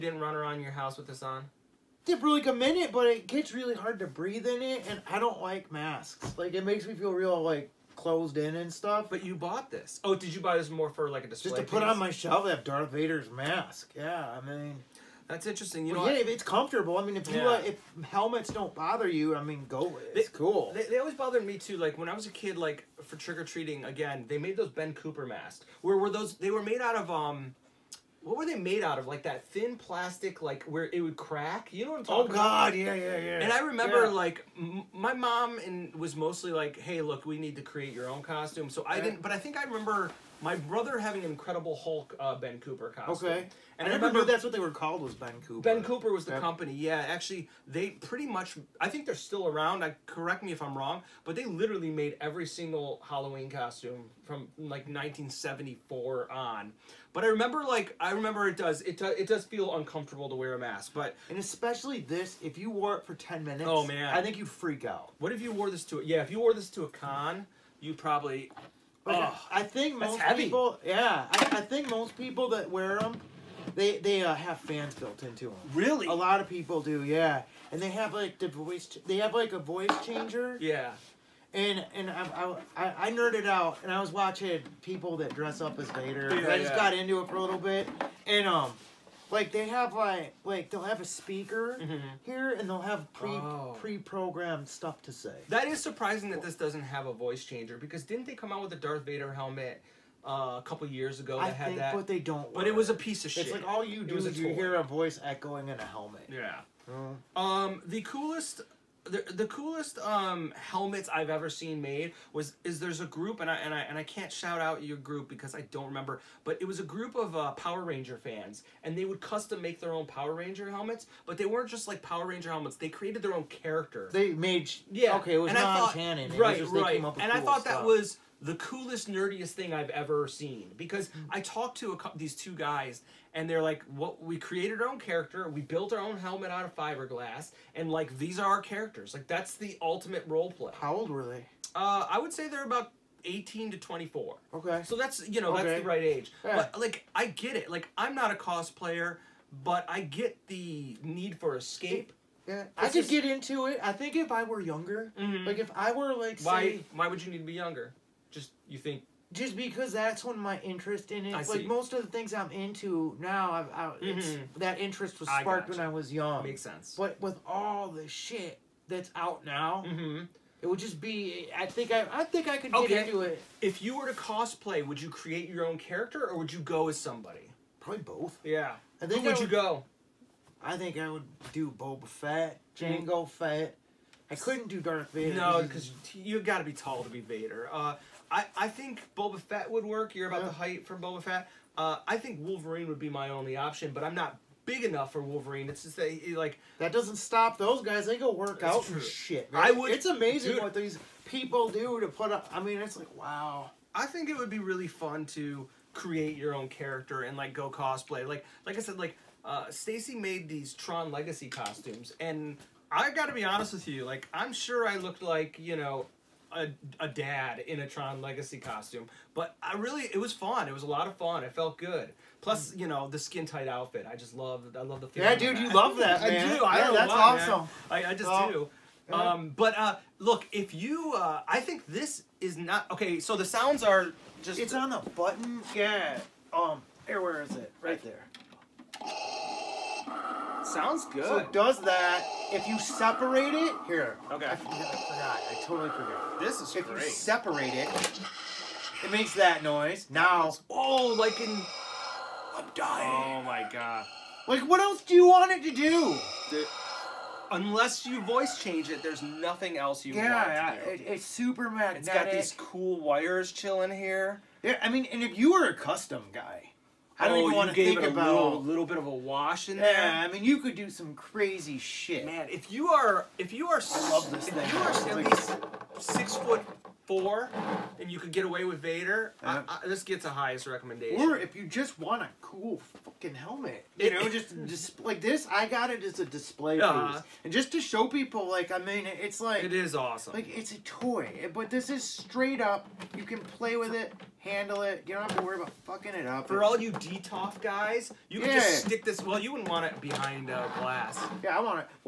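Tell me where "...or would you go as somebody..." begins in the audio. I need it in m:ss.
2:56.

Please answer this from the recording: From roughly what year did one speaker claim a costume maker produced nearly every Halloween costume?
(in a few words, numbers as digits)
1974.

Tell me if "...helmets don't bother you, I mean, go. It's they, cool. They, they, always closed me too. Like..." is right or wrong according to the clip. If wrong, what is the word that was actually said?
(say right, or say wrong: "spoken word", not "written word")
wrong: "bothered", not "closed".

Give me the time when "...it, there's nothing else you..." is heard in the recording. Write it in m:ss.
4:18.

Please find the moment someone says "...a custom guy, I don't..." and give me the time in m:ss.
4:25.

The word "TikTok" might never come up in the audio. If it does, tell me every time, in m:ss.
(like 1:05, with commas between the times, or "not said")
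not said.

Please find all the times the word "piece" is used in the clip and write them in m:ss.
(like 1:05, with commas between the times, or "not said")
0:11, 1:42, 4:47.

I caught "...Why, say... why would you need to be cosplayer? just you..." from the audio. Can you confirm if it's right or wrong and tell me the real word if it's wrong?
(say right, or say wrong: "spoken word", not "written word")
wrong: "younger", not "cosplayer".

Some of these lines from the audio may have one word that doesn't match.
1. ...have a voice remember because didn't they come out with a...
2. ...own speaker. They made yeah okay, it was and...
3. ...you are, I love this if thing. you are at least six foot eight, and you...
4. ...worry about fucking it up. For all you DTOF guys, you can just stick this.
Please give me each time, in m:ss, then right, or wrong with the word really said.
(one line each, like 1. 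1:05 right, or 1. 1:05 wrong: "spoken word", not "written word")
1. 1:36 wrong: "changer", not "remember"
2. 2:03 wrong: "character", not "speaker"
3. 4:33 wrong: "four", not "eight"
4. 4:55 right.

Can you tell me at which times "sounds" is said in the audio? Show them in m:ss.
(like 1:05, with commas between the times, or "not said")
3:53, 4:00.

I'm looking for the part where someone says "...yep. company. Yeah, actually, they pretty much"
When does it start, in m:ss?
0:46.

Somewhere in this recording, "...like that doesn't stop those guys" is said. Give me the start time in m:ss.
3:16.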